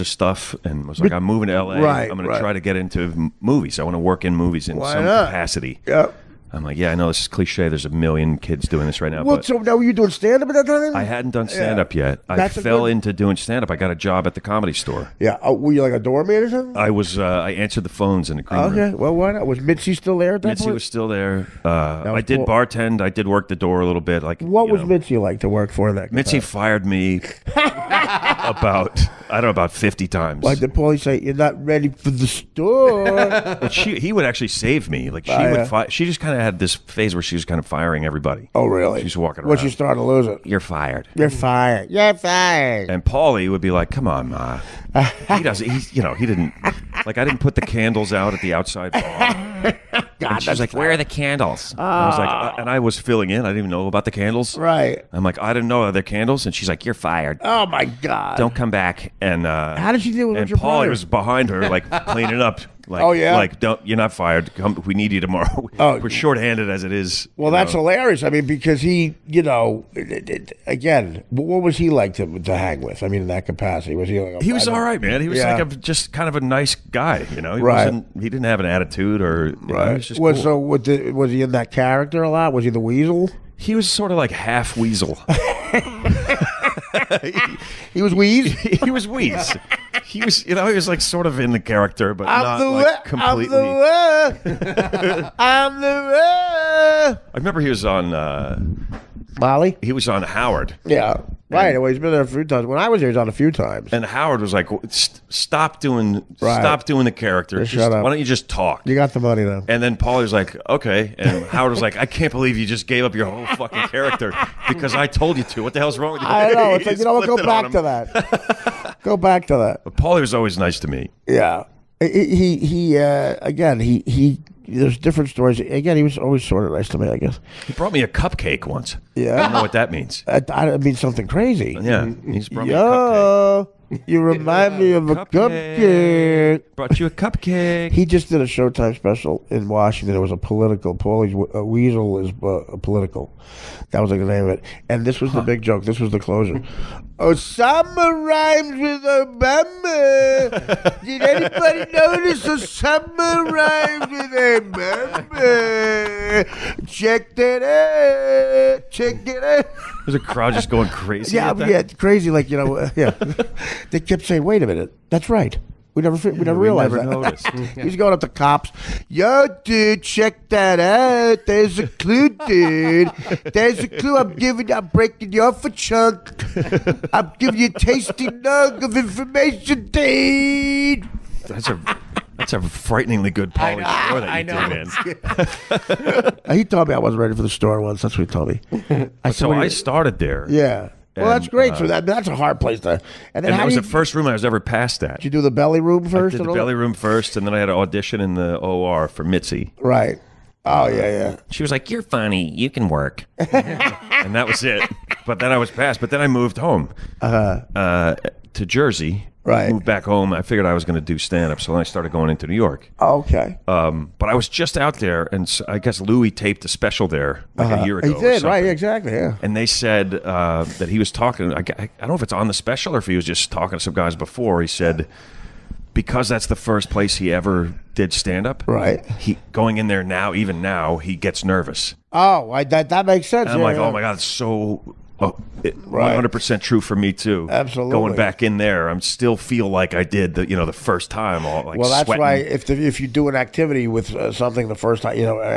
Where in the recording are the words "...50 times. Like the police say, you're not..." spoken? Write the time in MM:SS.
00:29.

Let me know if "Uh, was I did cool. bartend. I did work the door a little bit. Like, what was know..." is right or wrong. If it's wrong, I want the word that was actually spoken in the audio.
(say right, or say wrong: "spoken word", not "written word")
right.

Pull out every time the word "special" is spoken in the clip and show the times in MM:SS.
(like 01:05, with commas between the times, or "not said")
02:18, 03:36, 03:42.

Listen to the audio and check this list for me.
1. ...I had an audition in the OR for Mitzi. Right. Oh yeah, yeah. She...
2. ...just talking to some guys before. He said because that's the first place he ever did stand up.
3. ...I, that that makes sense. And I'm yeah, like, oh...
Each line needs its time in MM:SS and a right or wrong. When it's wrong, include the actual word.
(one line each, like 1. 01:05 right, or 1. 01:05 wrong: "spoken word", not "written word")
1. 03:17 right
2. 03:43 right
3. 03:52 right.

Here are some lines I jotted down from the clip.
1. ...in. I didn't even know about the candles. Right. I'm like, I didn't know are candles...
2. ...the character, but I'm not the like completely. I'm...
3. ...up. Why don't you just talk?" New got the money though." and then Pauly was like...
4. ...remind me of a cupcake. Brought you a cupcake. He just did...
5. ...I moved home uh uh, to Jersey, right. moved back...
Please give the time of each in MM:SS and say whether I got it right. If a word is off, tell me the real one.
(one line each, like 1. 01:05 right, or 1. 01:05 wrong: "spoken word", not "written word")
1. 00:53 right
2. 01:31 right
3. 01:47 wrong: "You", not "New"
4. 02:14 right
5. 03:26 right.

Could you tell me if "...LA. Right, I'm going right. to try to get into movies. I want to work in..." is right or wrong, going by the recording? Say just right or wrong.
right.